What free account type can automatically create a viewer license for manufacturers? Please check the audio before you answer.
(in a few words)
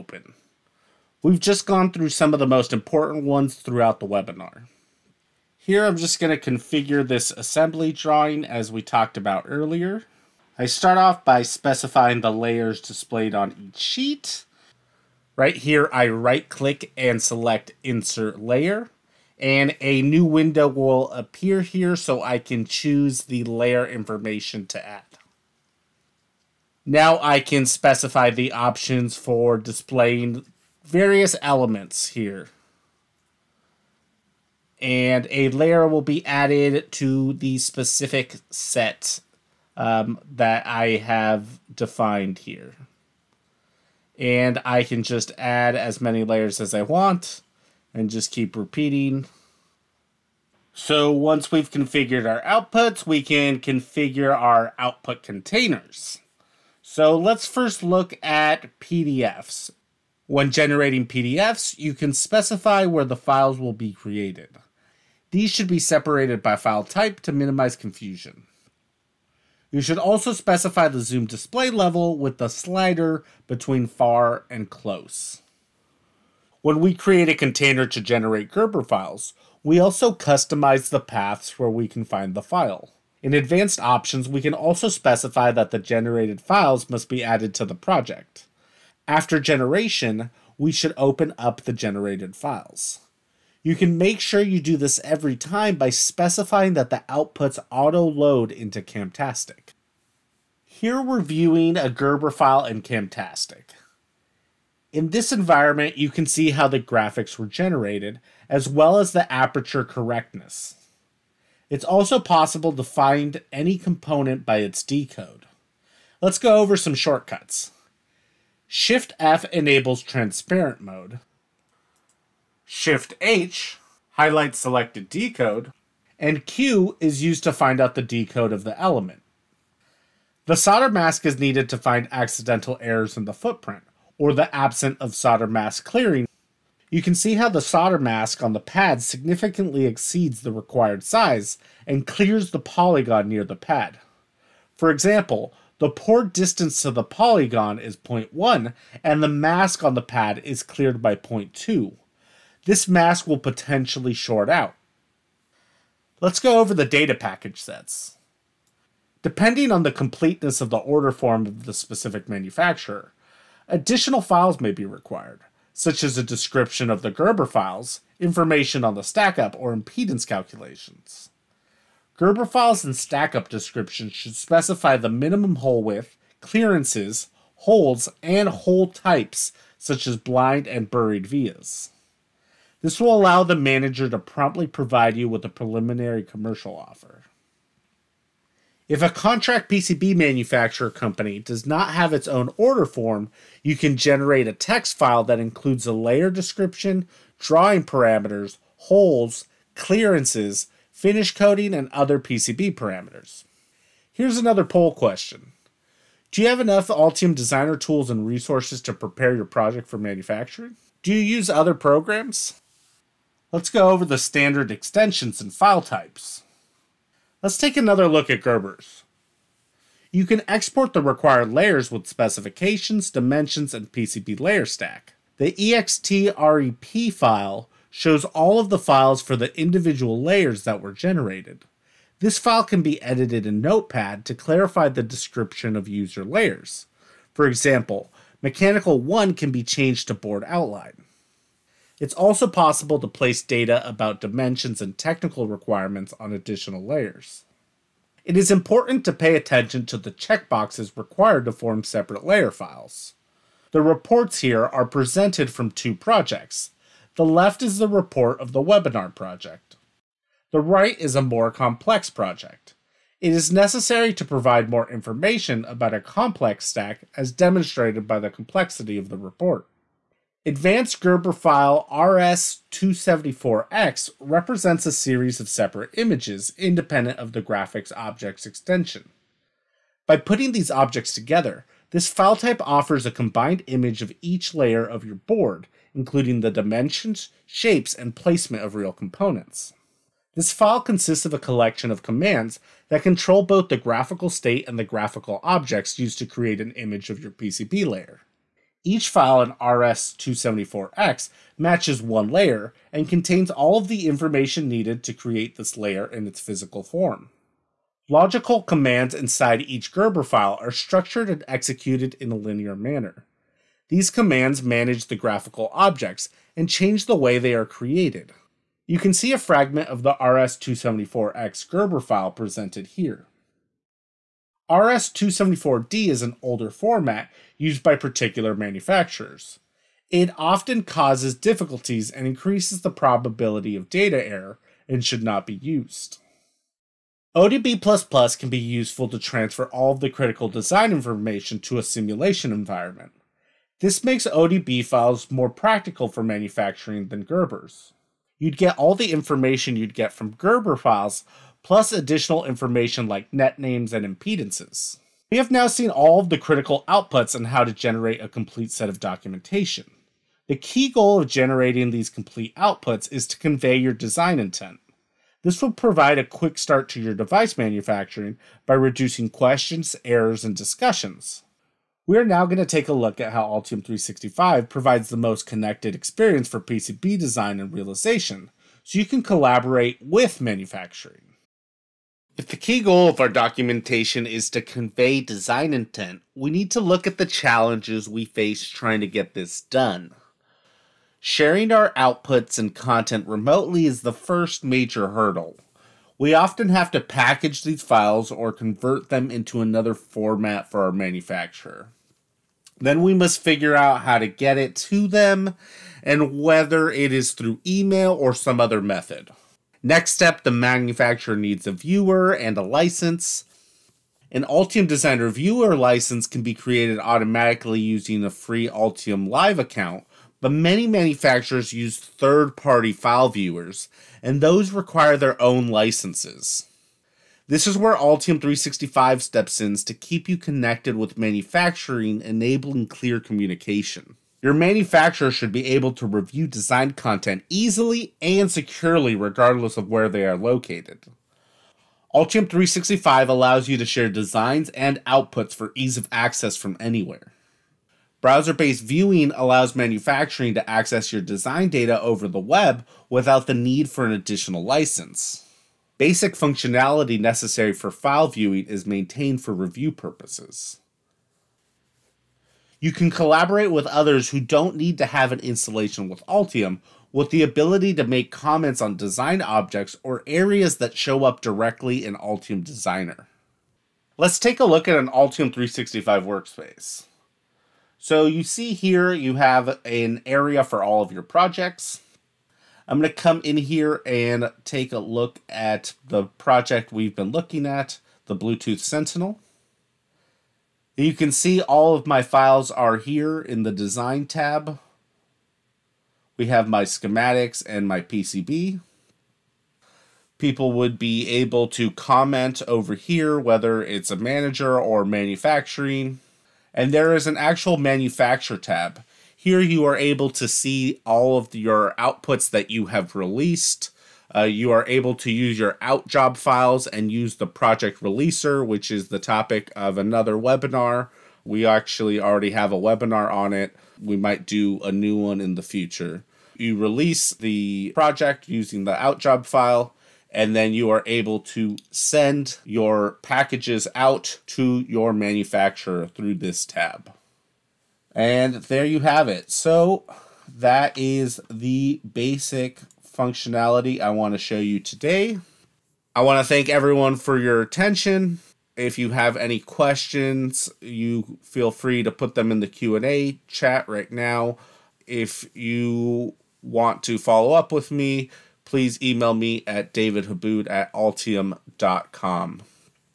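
Altium Live.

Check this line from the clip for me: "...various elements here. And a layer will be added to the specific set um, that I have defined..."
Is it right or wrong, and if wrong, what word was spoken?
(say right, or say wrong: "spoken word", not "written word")
right.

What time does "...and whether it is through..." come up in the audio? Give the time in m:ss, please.
6:46.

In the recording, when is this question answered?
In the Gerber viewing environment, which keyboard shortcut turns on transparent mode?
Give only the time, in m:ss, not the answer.
1:58.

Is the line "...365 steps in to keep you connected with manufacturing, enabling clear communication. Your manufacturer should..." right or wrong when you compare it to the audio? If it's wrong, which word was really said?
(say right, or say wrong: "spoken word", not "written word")
right.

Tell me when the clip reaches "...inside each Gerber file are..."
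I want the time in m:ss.
5:09.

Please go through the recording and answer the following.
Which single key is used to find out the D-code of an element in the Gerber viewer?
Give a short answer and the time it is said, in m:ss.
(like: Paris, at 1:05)
Q, at 2:06.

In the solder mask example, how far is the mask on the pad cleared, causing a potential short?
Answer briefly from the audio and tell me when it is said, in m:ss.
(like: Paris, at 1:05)
0.2, at 2:31.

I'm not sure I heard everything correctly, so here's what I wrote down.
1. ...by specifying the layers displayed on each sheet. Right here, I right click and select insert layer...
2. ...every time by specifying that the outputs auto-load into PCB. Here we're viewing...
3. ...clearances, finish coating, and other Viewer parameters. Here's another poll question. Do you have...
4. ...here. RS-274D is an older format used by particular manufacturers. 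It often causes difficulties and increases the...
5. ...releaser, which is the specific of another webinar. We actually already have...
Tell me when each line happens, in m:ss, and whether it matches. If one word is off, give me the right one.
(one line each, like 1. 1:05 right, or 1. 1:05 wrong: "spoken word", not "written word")
1. 0:11 right
2. 1:35 wrong: "Camtastic", not "PCB"
3. 3:19 wrong: "PCB", not "Viewer"
4. 5:22 right
5. 8:38 wrong: "topic", not "specific".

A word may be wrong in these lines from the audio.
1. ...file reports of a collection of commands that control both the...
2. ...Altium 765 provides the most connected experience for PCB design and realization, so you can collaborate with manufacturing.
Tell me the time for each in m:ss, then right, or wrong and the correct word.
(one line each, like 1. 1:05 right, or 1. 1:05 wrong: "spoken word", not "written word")
1. 4:50 wrong: "consists", not "reports"
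2. 6:13 wrong: "365", not "765".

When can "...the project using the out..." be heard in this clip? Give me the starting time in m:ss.
8:47.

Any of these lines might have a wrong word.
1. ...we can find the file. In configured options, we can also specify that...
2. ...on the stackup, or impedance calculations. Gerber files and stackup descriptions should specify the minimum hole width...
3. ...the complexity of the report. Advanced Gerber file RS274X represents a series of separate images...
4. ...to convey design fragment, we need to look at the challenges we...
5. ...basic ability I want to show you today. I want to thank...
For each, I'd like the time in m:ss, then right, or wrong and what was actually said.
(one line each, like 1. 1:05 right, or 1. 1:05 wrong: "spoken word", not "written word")
1. 1:21 wrong: "advanced", not "configured"
2. 2:48 right
3. 4:28 right
4. 6:24 wrong: "intent", not "fragment"
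5. 9:02 wrong: "functionality", not "ability".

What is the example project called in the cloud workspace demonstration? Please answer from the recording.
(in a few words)
Bluetooth Sentinel.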